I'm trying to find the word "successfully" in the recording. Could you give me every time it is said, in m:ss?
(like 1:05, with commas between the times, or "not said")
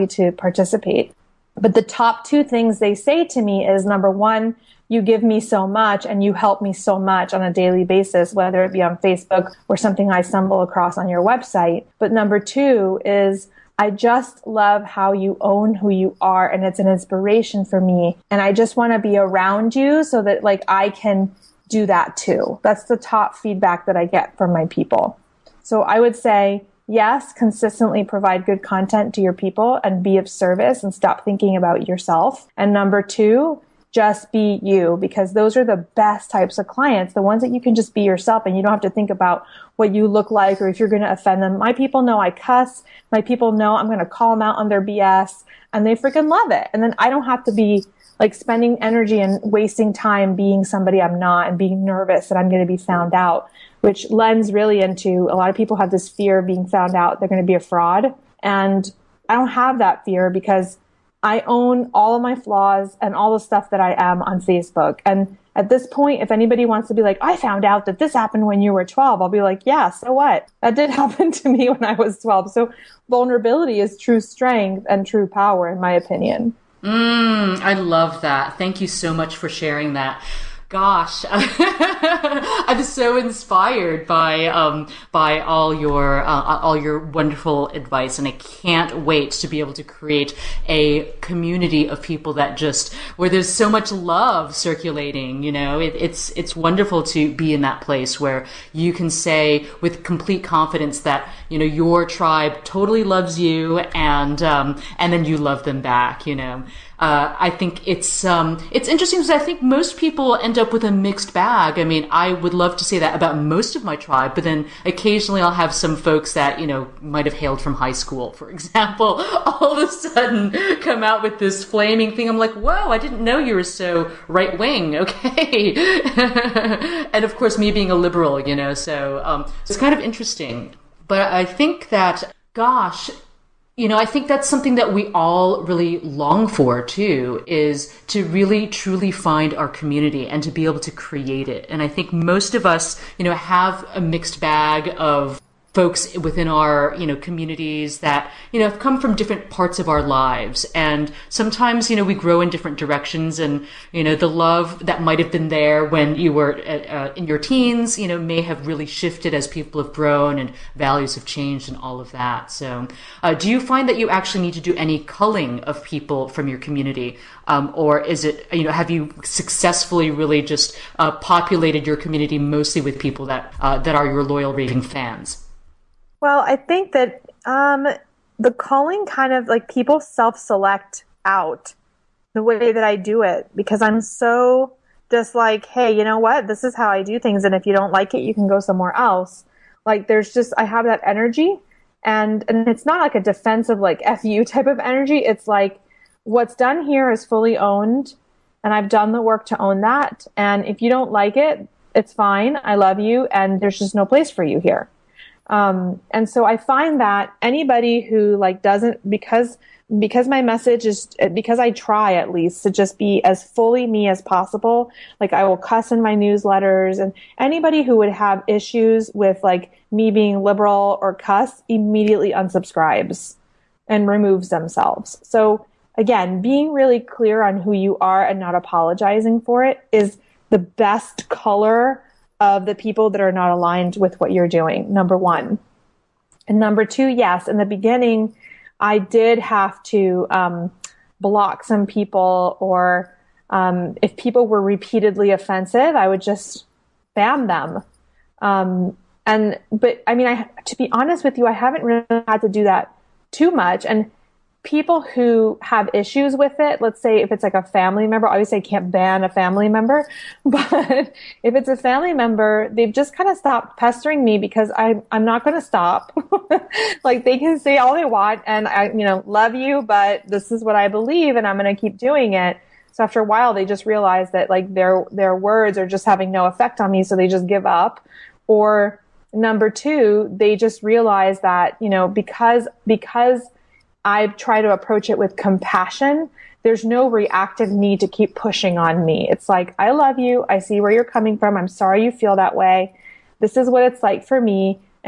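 2:49.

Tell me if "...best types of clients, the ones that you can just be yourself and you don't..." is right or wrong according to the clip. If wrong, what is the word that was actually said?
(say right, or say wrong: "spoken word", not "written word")
right.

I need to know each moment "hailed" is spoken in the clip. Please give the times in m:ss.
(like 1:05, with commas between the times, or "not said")
1:57.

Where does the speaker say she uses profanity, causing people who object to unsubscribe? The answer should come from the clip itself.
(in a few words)
Newsletters.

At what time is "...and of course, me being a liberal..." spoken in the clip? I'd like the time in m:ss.
2:07.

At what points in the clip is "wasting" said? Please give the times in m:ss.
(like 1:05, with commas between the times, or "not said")
0:49.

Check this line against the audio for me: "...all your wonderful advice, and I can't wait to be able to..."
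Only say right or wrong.
right.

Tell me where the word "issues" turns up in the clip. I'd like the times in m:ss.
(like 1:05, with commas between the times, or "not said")
3:38, 4:15.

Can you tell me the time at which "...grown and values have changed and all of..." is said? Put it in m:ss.
2:39.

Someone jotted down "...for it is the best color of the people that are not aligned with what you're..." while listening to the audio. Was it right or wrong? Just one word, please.
right.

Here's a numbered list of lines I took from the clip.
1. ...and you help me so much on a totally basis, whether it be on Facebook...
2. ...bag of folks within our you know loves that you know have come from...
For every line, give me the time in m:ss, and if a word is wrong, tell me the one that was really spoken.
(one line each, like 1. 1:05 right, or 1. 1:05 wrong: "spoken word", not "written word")
1. 0:06 wrong: "daily", not "totally"
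2. 2:24 wrong: "communities", not "loves".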